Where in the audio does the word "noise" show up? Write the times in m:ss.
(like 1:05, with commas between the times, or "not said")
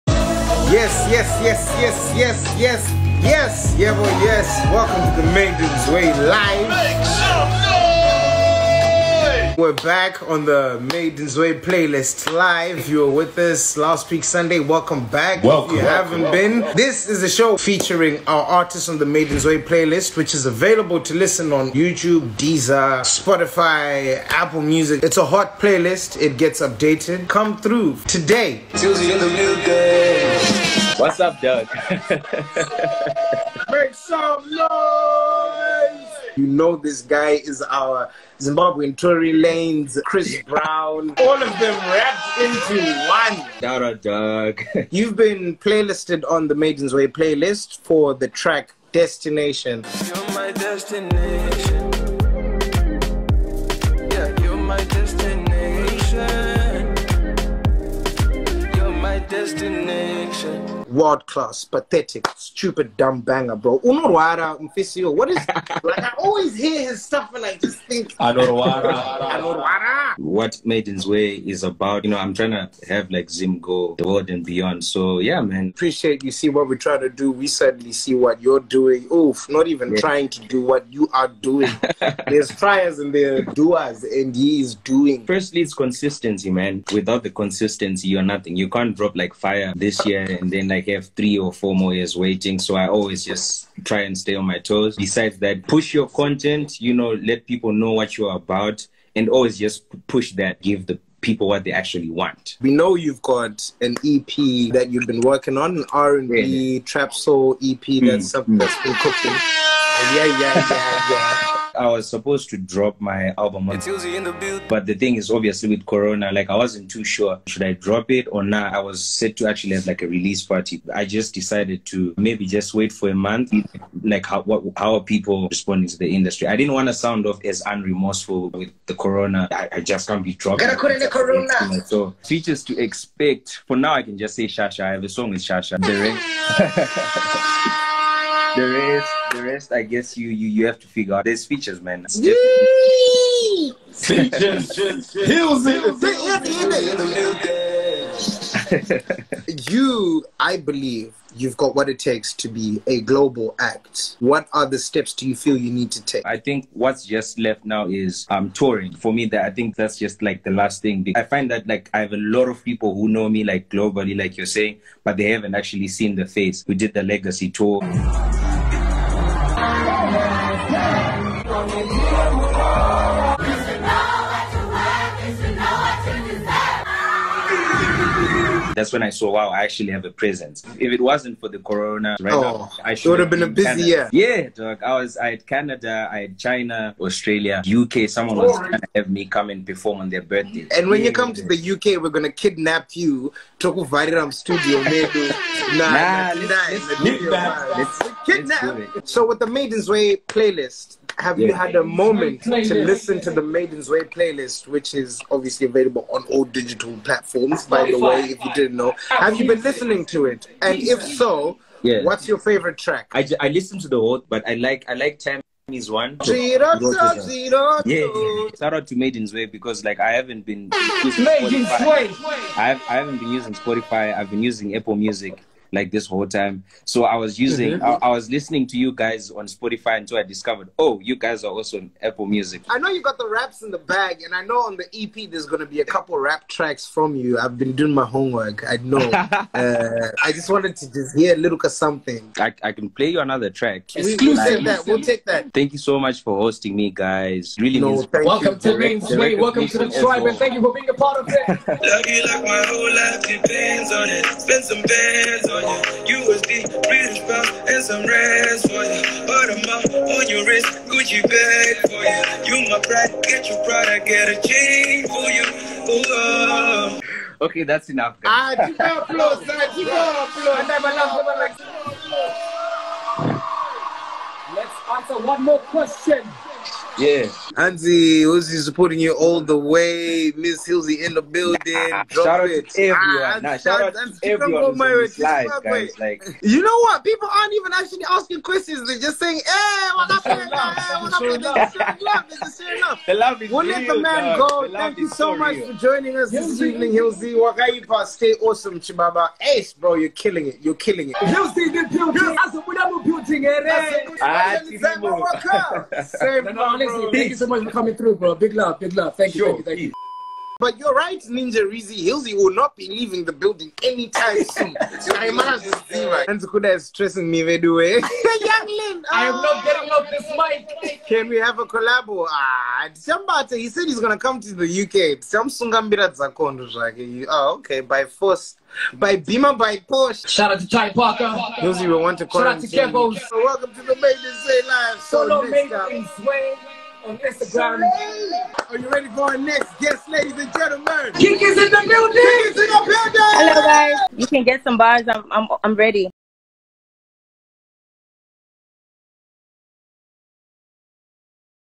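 0:09, 0:34.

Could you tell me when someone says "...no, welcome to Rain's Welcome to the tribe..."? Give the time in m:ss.
4:07.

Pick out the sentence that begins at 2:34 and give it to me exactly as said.
What are the steps do you feel you need to take?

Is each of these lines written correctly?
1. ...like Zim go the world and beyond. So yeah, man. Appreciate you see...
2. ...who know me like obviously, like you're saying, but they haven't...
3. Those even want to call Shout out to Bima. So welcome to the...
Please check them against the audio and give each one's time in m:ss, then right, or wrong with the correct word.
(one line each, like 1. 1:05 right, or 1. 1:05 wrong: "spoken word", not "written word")
1. 1:13 right
2. 2:42 wrong: "globally", not "obviously"
3. 5:31 wrong: "Kevos", not "Bima".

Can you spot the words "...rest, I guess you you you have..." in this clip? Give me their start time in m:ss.
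2:19.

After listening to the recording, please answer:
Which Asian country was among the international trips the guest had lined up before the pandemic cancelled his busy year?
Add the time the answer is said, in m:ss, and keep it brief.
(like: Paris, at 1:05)
China, at 3:06.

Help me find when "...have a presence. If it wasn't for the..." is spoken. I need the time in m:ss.
2:59.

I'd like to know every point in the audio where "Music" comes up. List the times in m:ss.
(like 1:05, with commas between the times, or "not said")
0:24, 3:44, 3:52.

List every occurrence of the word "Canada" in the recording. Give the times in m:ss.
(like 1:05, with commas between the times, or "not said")
3:05.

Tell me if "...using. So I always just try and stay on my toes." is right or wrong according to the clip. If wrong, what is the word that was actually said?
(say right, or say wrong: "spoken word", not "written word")
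wrong: "waiting", not "using".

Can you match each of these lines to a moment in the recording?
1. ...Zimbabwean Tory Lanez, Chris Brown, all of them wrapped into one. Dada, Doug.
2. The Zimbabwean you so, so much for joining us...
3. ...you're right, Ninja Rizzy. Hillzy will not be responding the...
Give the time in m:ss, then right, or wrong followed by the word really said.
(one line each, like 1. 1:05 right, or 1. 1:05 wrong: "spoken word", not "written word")
1. 0:38 right
2. 4:54 wrong: "Thank", not "Zimbabwean"
3. 5:10 wrong: "leaving", not "responding".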